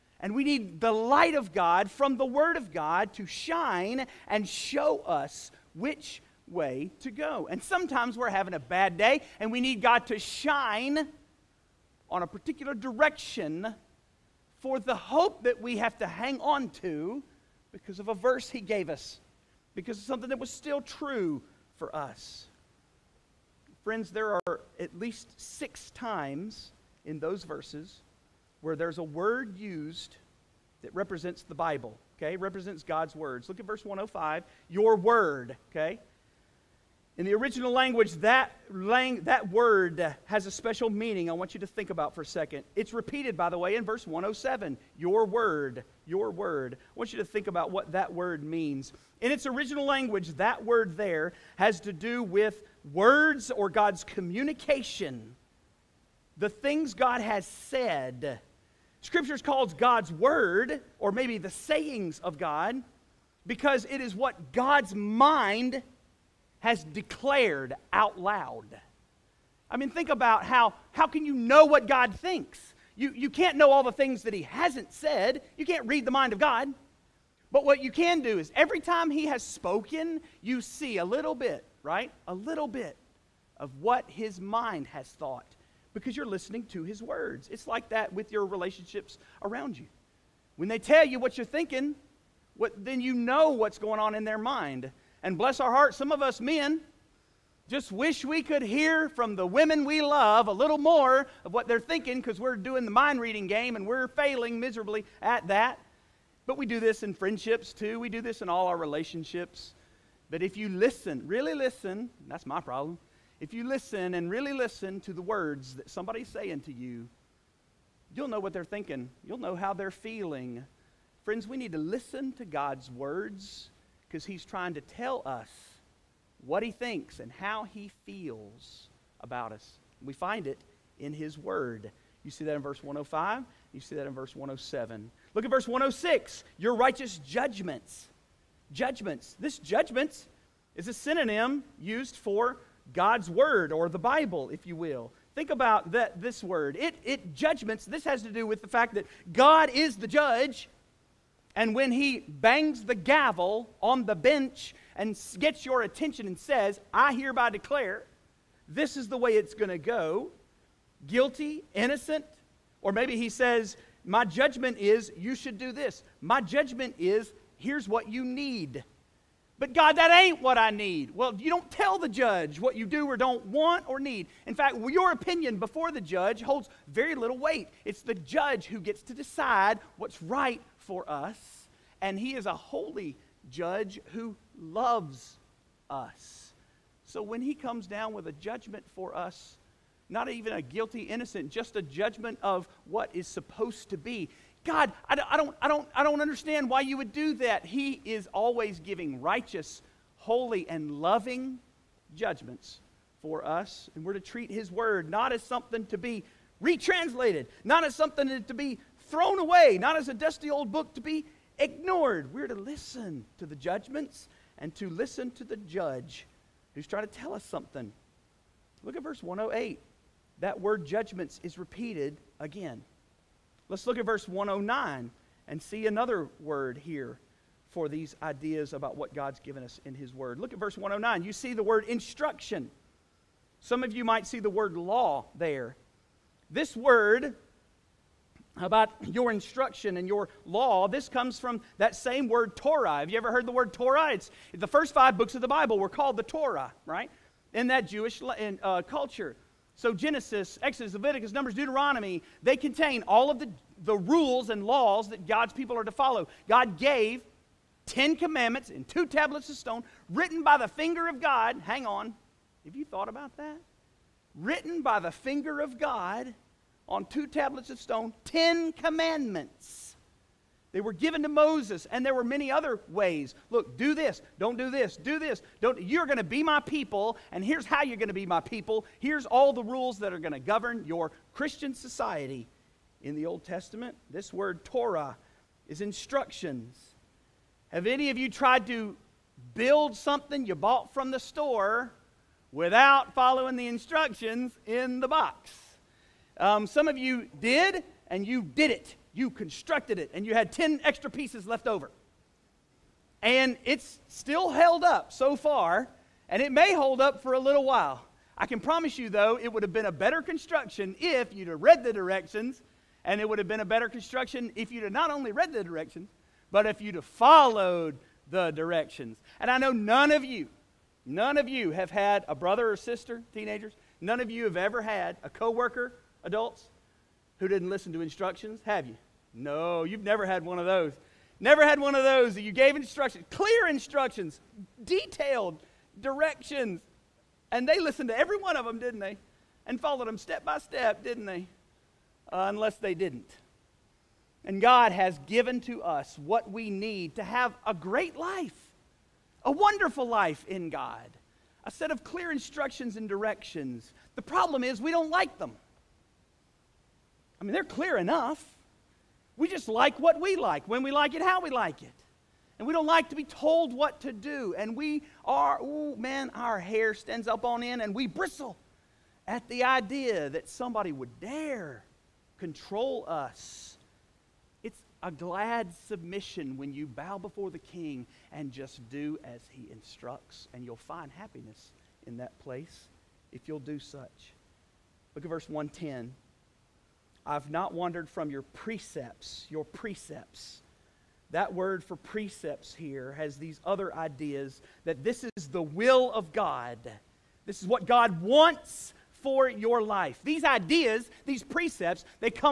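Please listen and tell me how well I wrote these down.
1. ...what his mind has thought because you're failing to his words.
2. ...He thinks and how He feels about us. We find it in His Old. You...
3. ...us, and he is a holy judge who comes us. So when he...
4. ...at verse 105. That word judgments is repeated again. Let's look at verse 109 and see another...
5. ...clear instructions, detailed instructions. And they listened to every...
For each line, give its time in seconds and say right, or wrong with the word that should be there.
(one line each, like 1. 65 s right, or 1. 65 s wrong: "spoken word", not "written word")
1. 83 s wrong: "listening", not "failing"
2. 126 s wrong: "Word", not "Old"
3. 181 s wrong: "loves", not "comes"
4. 218 s wrong: "108", not "105"
5. 333 s wrong: "directions", not "instructions".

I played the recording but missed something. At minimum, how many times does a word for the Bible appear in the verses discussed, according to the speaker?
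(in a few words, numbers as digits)
6.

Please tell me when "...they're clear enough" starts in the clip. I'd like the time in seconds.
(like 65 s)
357 s.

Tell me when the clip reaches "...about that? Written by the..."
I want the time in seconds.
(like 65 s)
263 s.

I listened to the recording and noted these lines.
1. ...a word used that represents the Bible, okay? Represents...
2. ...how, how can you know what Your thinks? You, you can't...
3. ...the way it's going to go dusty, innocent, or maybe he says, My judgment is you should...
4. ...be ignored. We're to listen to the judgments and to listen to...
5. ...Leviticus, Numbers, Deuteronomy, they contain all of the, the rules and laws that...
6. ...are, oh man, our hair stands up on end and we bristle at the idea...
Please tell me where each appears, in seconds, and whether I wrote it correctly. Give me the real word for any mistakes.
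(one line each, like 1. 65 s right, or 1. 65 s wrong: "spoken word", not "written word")
1. 28 s right
2. 70 s wrong: "God", not "Your"
3. 159 s wrong: "guilty", not "dusty"
4. 211 s right
5. 250 s right
6. 365 s right.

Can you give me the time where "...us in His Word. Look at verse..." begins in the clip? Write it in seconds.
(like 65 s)
229 s.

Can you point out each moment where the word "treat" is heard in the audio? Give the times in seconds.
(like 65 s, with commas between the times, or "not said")
204 s.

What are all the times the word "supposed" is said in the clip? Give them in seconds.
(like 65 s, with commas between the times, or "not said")
193 s.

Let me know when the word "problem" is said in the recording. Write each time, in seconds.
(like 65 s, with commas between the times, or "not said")
112 s, 354 s.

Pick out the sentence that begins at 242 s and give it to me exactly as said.
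Have you ever heard the word Torah?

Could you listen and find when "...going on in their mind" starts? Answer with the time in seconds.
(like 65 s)
93 s.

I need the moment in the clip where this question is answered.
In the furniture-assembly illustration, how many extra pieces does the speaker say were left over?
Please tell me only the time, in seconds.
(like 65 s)
300 s.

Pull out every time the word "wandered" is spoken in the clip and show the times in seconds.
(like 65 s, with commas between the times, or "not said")
387 s.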